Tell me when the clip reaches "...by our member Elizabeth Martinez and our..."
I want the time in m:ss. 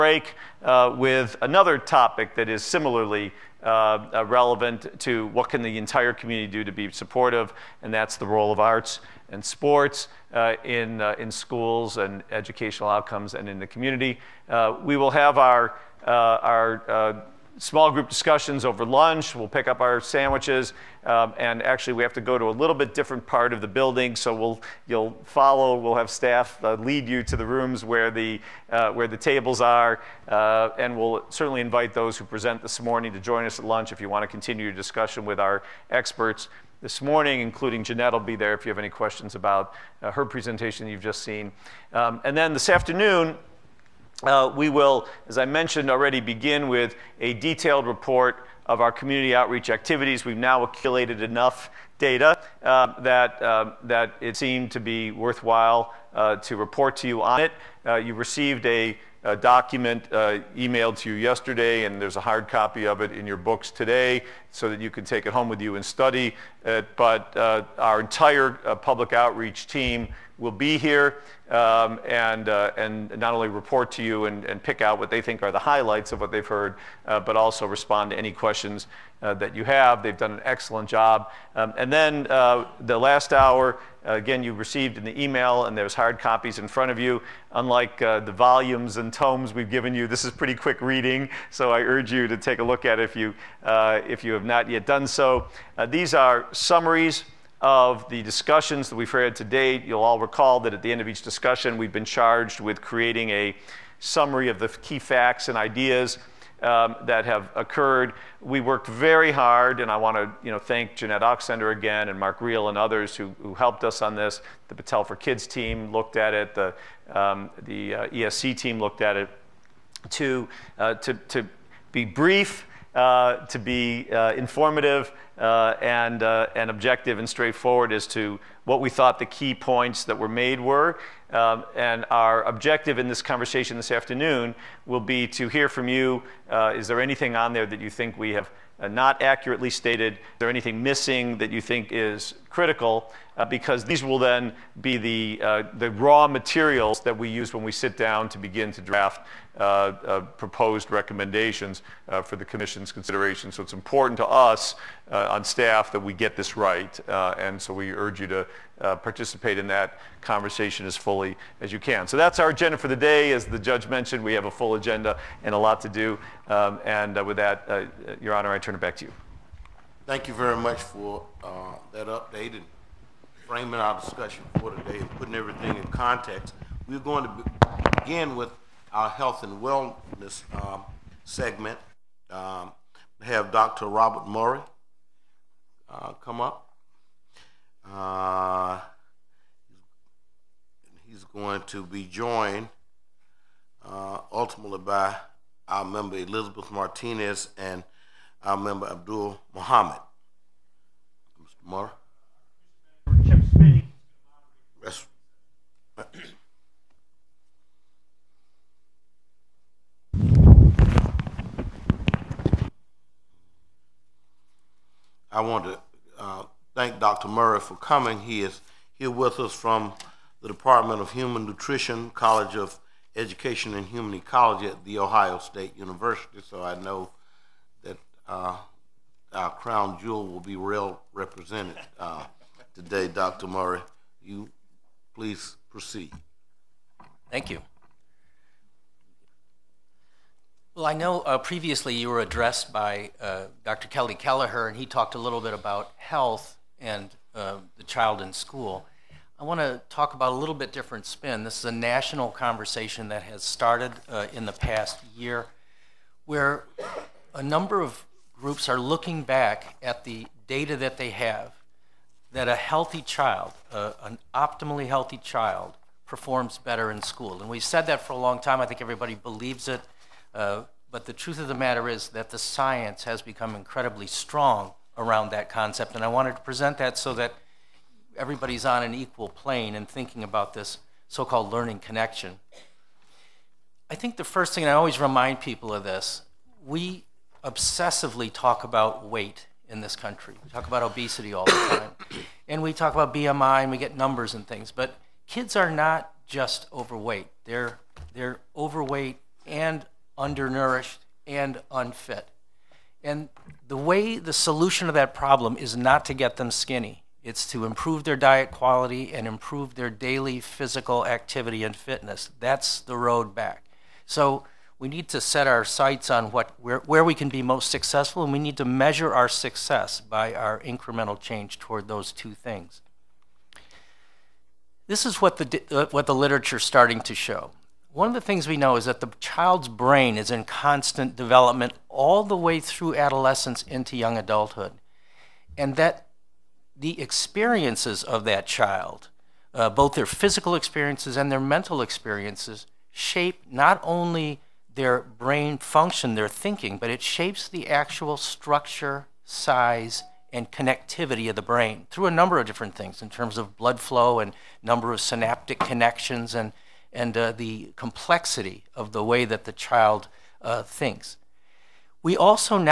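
3:14.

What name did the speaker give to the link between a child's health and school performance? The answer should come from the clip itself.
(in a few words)
learning connection.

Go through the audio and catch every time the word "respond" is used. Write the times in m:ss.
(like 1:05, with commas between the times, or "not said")
1:17.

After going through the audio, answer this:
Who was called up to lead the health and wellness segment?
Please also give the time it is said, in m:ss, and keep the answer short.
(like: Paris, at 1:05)
Dr. Robert Murray, at 3:03.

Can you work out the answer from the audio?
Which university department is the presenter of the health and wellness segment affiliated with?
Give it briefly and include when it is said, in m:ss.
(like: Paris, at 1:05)
Department of Human Nutrition, at 3:40.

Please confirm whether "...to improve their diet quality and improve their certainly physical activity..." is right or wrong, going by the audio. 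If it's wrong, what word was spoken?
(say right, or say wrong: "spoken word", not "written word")
wrong: "daily", not "certainly".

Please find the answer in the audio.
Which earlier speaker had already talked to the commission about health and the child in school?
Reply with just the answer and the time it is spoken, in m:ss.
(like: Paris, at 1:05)
Dr. Kelly Kelleher, at 4:03.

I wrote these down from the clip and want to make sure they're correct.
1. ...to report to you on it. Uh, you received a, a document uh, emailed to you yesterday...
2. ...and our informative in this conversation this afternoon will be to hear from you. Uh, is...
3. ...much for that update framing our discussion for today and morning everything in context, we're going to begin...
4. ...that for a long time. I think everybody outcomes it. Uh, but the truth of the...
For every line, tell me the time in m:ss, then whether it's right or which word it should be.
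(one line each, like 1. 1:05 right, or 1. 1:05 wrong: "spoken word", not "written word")
1. 0:56 right
2. 2:11 wrong: "objective", not "informative"
3. 2:50 wrong: "putting", not "morning"
4. 4:27 wrong: "believes", not "outcomes".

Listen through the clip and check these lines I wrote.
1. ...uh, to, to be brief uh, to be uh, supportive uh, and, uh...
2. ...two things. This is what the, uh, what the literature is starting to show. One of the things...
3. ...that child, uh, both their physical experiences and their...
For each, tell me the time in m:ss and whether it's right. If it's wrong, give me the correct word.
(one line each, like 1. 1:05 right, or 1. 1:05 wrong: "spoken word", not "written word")
1. 2:00 wrong: "informative", not "supportive"
2. 5:22 right
3. 5:38 right.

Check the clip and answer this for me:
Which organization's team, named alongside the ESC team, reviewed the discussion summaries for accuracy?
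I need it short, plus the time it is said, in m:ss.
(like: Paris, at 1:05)
Battelle for Kids, at 1:54.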